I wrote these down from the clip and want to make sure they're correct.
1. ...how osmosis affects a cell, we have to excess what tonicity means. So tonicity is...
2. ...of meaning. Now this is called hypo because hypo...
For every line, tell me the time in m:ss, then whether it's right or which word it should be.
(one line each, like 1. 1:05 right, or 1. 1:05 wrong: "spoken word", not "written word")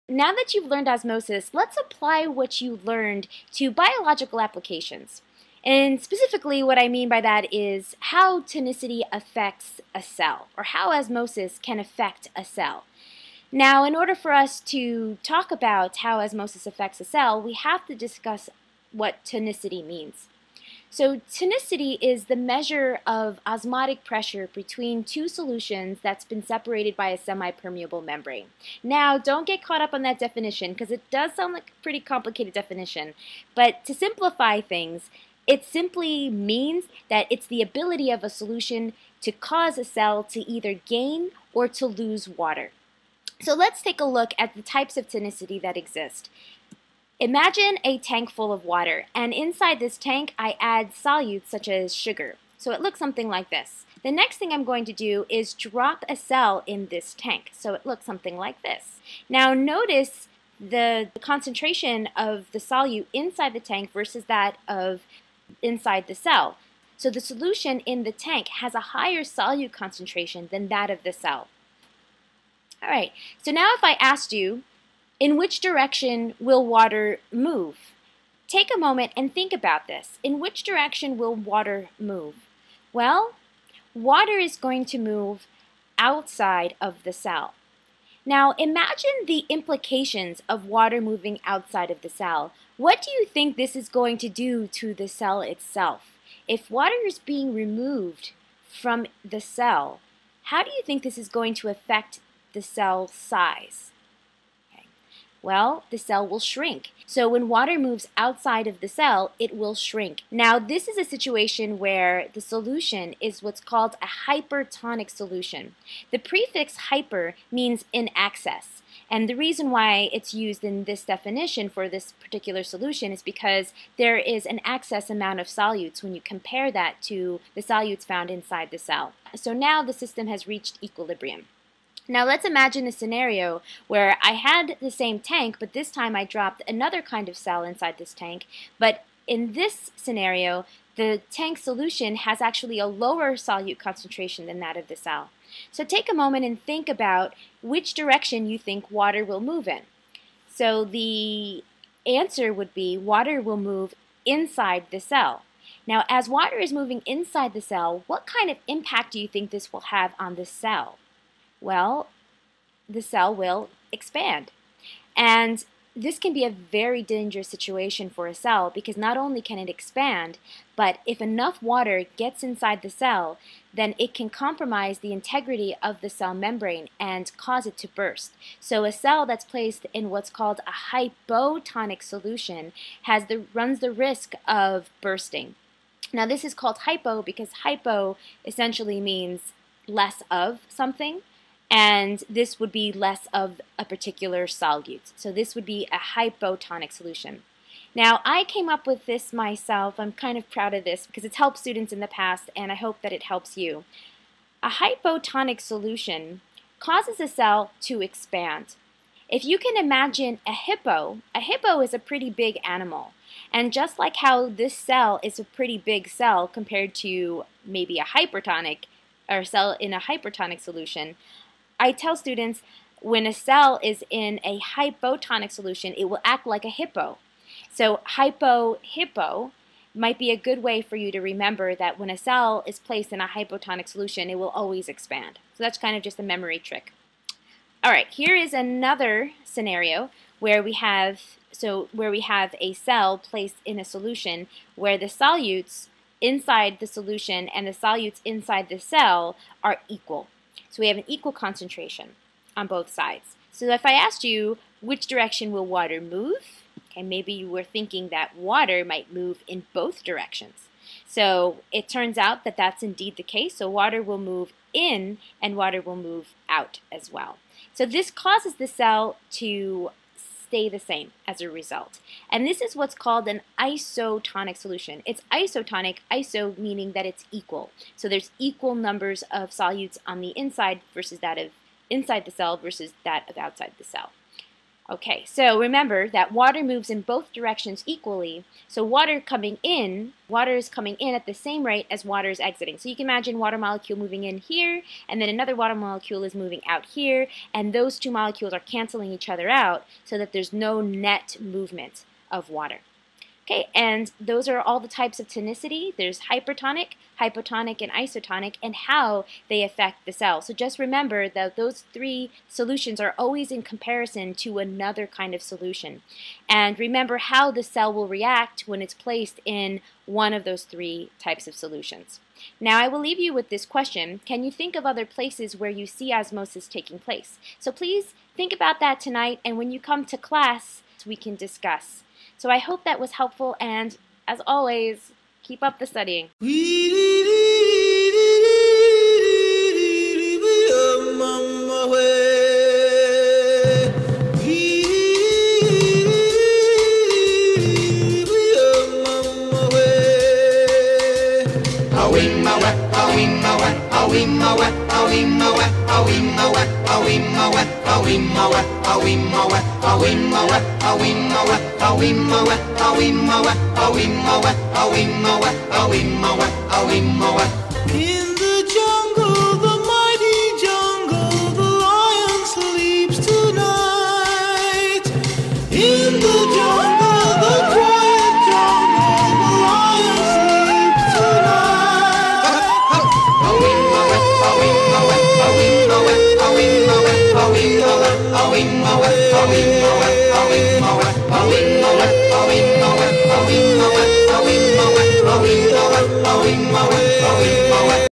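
1. 0:15 wrong: "discuss", not "excess"
2. 3:04 wrong: "bursting", not "meaning".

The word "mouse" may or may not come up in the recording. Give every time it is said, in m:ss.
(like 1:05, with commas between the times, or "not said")
not said.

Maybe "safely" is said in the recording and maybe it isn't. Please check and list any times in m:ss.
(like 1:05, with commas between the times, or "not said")
not said.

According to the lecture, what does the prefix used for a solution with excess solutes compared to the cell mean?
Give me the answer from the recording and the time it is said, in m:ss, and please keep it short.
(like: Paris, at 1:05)
in excess, at 1:57.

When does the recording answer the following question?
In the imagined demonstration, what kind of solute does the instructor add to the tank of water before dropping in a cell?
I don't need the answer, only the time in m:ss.
0:51.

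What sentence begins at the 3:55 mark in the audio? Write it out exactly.
So that's kind of just a memory trick.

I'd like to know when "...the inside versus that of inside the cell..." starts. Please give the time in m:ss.
4:40.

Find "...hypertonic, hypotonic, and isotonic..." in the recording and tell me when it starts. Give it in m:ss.
5:06.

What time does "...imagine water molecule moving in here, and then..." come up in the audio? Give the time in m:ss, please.
4:53.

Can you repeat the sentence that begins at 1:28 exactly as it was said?
Now imagine the implications of water moving outside of the cell.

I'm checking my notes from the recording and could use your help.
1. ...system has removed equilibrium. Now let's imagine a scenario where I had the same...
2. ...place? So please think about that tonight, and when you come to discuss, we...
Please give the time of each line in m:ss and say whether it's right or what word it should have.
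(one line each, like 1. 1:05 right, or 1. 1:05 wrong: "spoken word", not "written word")
1. 2:09 wrong: "reached", not "removed"
2. 5:26 wrong: "class", not "discuss".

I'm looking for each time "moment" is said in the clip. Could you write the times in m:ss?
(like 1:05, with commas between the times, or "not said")
1:18, 2:26.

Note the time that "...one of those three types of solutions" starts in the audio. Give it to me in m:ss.
5:20.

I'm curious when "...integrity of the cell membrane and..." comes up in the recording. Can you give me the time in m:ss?
2:55.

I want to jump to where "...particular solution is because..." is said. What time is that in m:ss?
2:02.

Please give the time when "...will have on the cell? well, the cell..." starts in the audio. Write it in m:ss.
2:39.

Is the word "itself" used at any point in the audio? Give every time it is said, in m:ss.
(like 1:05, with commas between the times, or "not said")
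1:35.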